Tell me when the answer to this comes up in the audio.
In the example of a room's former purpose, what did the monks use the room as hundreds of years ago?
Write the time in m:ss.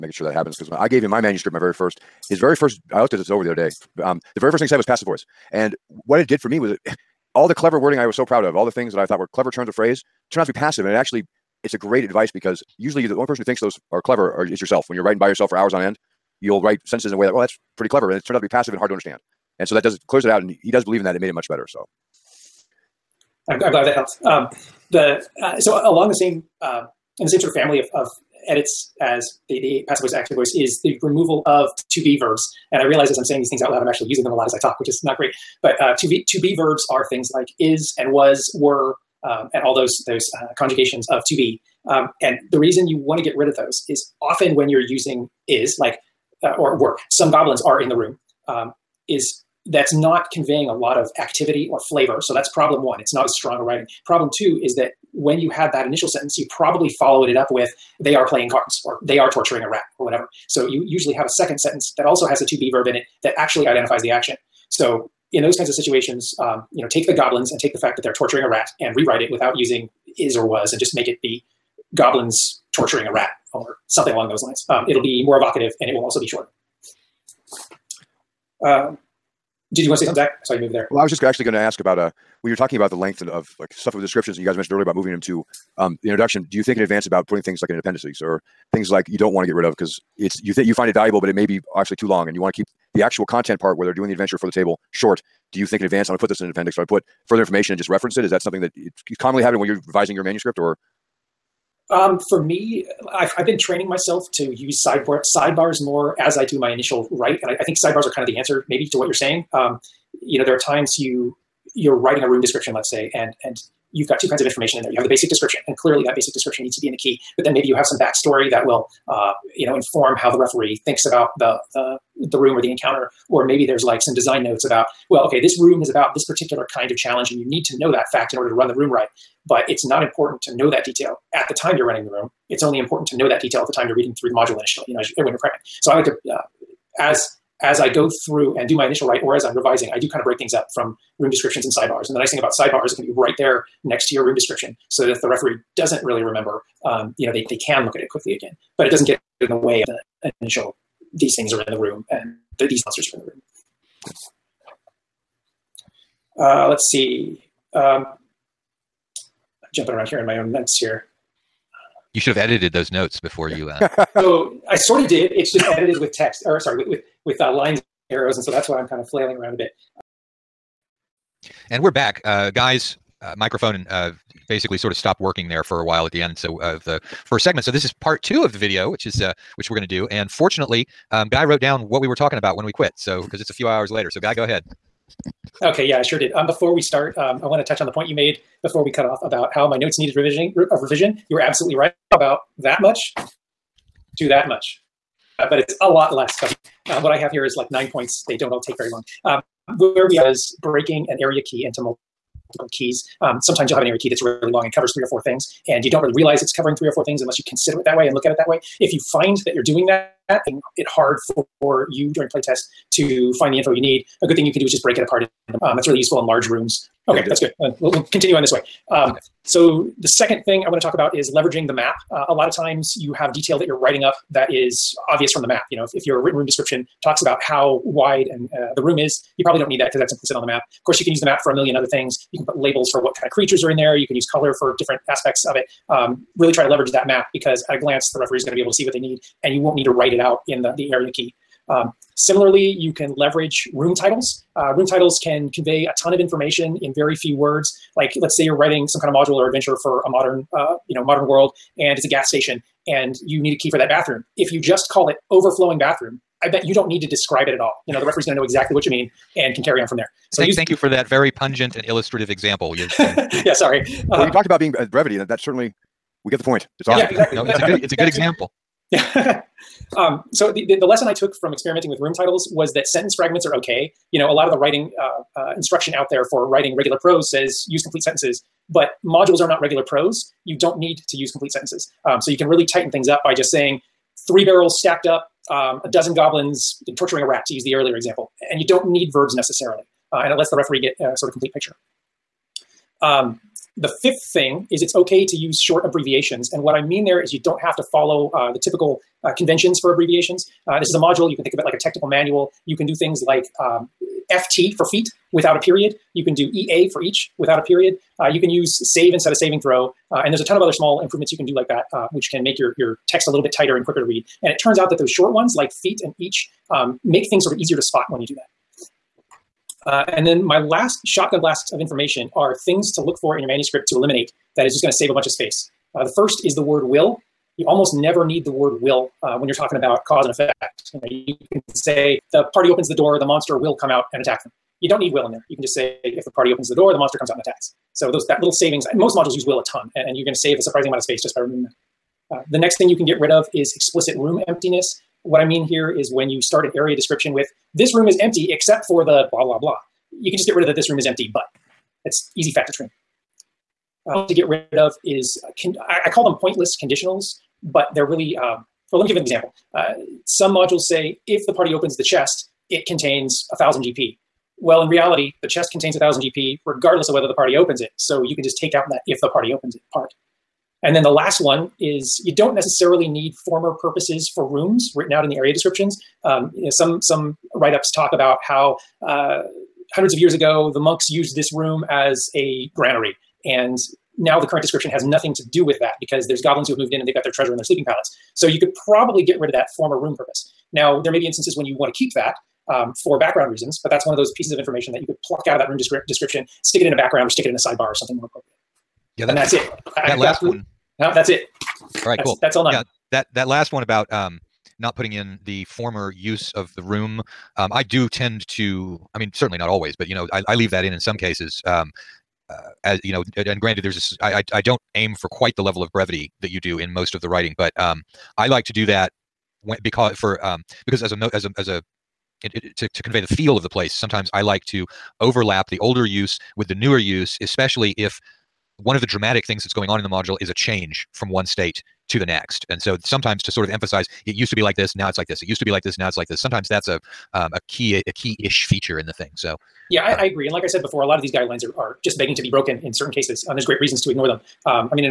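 6:22.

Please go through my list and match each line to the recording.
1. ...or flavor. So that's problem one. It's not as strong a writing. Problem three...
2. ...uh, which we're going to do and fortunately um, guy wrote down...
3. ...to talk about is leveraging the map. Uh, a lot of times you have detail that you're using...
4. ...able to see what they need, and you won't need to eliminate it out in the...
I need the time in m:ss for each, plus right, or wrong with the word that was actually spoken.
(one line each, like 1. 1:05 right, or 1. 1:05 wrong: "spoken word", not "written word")
1. 0:51 wrong: "two", not "three"
2. 2:59 right
3. 3:40 wrong: "writing", not "using"
4. 3:58 wrong: "write", not "eliminate".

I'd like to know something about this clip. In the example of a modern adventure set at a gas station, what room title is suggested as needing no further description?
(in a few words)
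Overflowing bathroom.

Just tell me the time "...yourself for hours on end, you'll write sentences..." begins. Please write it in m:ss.
0:15.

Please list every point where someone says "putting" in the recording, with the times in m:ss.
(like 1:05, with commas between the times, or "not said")
1:27, 6:44.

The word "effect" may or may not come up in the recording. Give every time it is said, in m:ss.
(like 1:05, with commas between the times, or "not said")
5:30.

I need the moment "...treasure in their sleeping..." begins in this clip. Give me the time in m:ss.
6:27.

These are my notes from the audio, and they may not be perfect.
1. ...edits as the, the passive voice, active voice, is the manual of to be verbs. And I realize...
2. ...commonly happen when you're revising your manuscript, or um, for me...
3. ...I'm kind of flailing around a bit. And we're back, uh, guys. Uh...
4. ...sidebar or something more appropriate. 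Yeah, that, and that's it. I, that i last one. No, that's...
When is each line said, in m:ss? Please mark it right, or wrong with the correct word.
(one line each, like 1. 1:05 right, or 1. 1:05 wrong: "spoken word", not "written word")
1. 0:28 wrong: "removal", not "manual"
2. 1:39 right
3. 2:48 right
4. 6:37 right.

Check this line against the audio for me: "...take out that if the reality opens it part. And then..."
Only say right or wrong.
wrong.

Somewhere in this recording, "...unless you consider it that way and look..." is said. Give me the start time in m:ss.
3:27.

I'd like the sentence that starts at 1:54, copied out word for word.
You have the basic description, and clearly that basic description needs to be in the key.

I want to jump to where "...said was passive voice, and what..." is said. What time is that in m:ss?
0:04.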